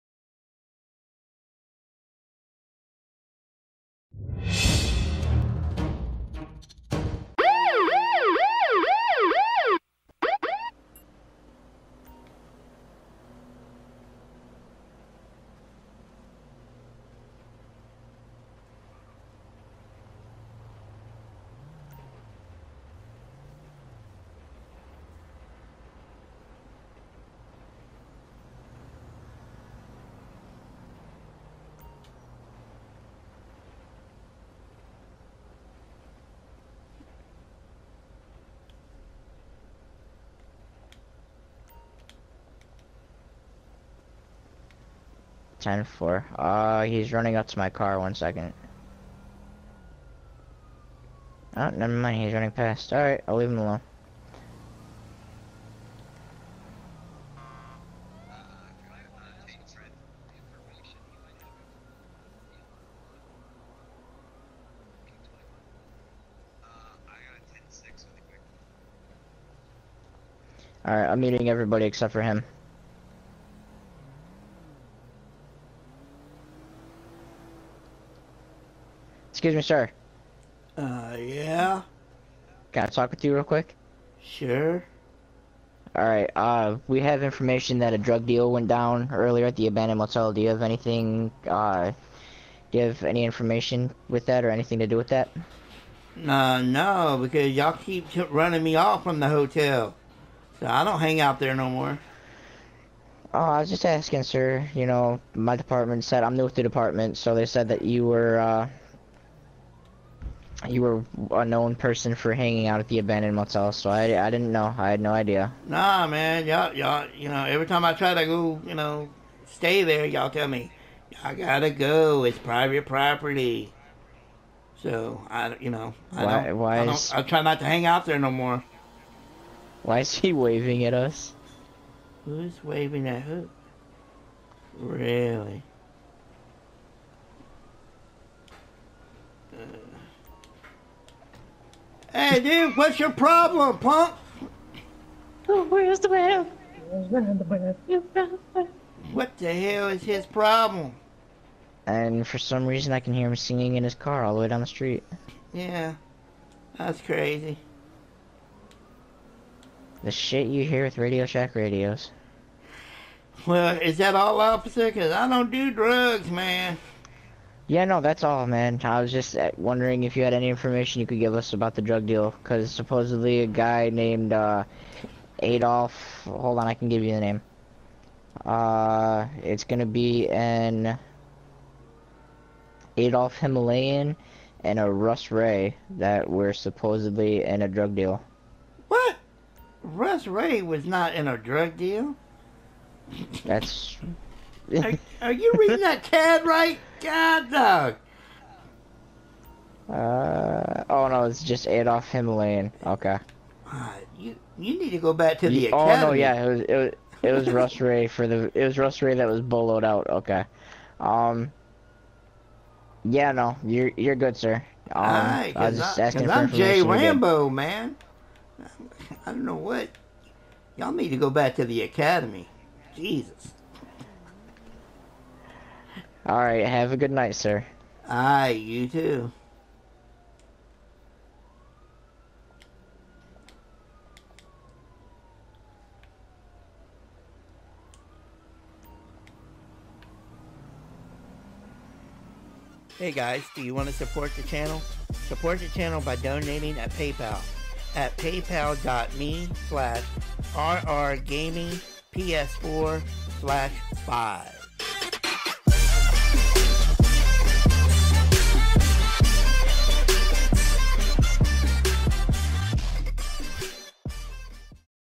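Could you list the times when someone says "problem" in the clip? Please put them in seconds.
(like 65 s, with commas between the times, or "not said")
143 s, 150 s.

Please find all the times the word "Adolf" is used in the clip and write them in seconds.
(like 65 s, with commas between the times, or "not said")
175 s, 182 s, 201 s.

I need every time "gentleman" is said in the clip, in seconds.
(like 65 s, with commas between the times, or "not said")
not said.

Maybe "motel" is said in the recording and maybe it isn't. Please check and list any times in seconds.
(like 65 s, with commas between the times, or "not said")
89 s, 113 s.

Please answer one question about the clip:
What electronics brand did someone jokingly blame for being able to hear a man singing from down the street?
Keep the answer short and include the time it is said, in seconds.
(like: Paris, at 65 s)
Radio Shack, at 160 s.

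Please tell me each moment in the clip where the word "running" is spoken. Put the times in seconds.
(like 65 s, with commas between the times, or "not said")
47 s, 52 s, 98 s.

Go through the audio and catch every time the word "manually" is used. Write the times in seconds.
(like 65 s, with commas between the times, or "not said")
not said.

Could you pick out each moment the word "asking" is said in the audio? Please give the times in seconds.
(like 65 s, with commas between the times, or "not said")
103 s, 216 s.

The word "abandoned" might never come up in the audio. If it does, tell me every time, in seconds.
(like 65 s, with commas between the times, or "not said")
89 s, 112 s.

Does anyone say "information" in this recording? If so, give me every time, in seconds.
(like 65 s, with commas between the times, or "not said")
87 s, 93 s, 170 s.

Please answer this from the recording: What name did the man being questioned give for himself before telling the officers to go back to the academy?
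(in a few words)
Jay Rambo.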